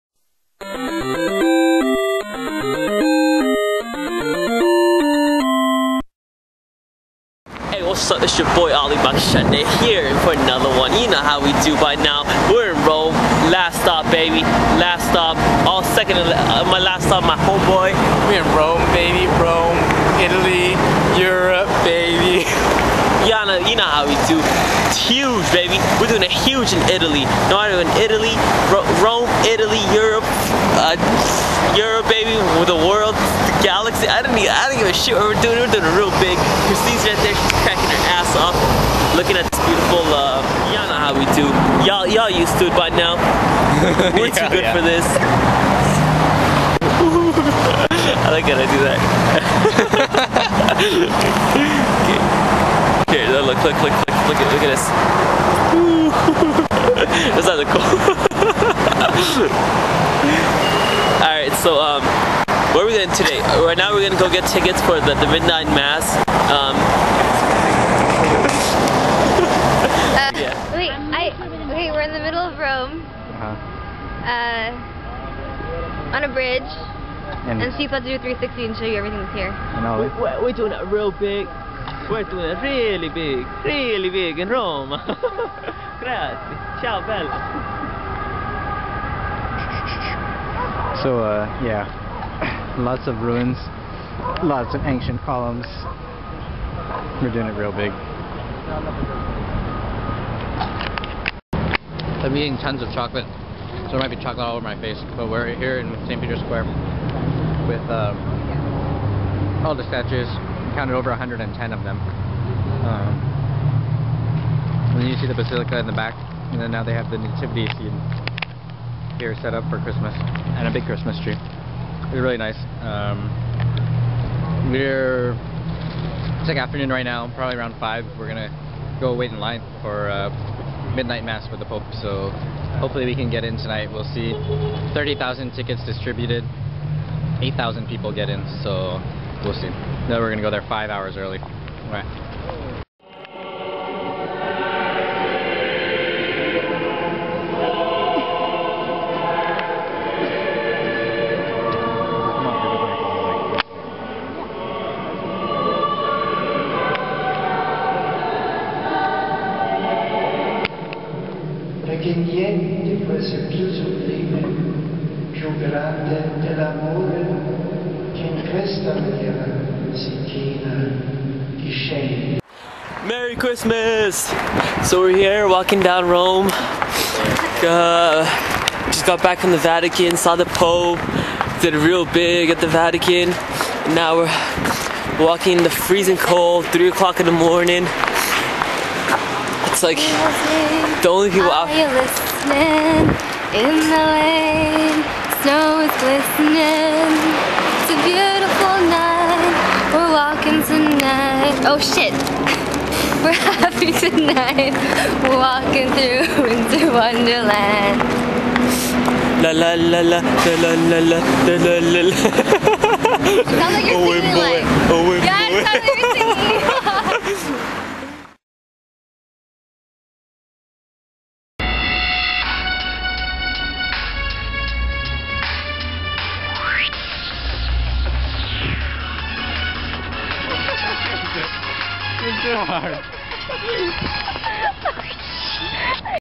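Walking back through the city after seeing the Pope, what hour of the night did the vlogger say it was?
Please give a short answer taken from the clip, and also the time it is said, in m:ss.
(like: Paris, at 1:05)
3 o'clock, at 3:06.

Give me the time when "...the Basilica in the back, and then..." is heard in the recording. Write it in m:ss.
1:55.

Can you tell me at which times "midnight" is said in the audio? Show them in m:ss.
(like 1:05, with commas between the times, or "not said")
1:05, 2:10.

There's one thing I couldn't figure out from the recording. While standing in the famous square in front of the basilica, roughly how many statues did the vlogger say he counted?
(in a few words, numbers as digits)
over 110.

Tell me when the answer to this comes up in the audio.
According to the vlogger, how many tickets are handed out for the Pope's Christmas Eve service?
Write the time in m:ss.
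2:14.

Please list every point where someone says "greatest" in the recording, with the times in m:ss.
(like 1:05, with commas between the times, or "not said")
not said.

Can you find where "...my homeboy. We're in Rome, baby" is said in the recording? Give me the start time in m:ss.
0:17.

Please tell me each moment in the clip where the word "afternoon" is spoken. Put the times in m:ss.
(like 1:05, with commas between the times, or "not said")
2:06.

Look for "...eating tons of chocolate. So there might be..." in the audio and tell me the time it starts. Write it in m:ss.
1:42.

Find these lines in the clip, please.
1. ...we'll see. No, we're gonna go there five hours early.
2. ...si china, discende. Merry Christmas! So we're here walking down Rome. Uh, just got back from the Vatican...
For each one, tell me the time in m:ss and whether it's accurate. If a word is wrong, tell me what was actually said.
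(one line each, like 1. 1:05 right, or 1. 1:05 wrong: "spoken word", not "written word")
1. 2:19 right
2. 2:49 right.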